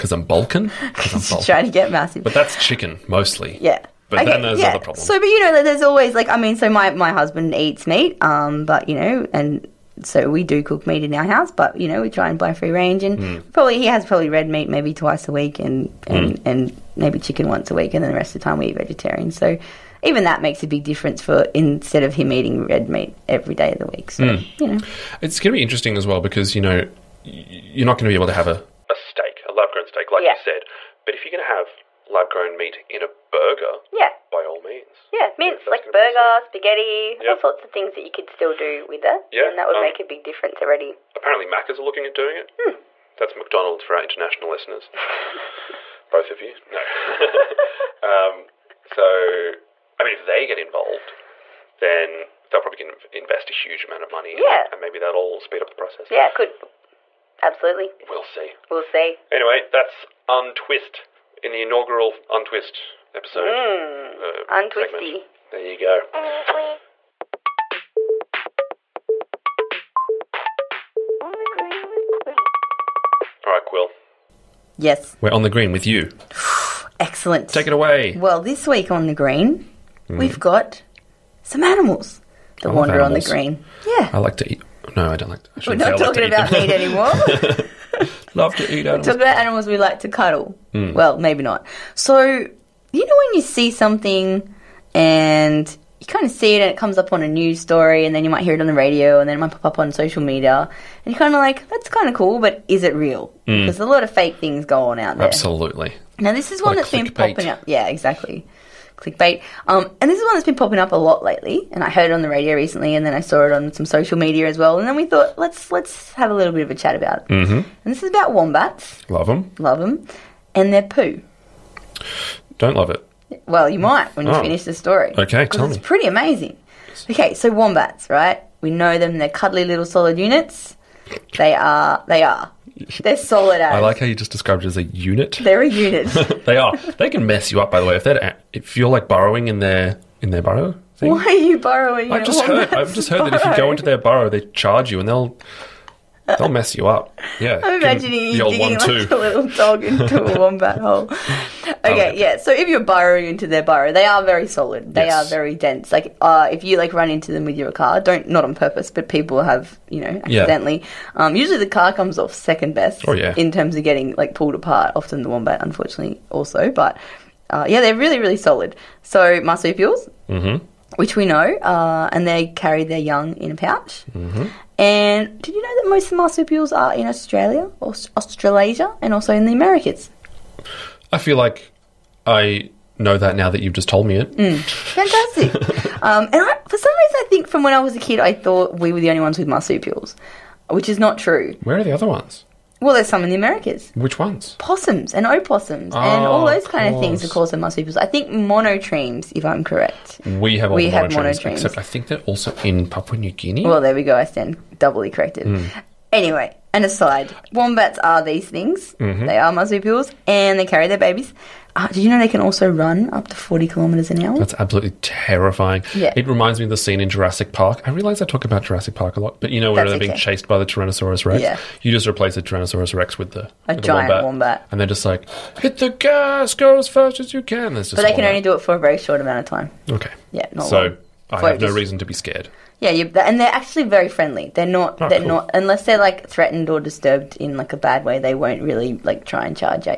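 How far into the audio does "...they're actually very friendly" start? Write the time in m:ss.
3:53.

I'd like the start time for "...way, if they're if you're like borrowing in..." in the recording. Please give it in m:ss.
2:17.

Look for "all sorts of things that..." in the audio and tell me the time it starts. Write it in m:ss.
0:37.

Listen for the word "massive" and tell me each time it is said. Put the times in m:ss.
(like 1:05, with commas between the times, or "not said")
0:01.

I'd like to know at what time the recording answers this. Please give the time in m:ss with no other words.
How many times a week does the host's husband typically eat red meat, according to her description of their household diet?
0:14.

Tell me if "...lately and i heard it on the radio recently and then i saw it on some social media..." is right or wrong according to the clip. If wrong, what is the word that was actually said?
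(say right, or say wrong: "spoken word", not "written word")
right.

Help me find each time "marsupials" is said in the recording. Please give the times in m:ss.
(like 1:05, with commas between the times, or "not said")
2:49, 2:56, 3:09, 3:17, 3:29.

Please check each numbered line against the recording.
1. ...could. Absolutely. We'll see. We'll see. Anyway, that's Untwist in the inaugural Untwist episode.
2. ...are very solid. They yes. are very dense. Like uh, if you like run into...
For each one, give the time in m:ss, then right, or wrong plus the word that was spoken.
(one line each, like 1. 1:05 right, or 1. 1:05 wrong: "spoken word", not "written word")
1. 0:56 right
2. 2:34 right.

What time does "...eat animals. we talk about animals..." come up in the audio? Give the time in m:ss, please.
1:28.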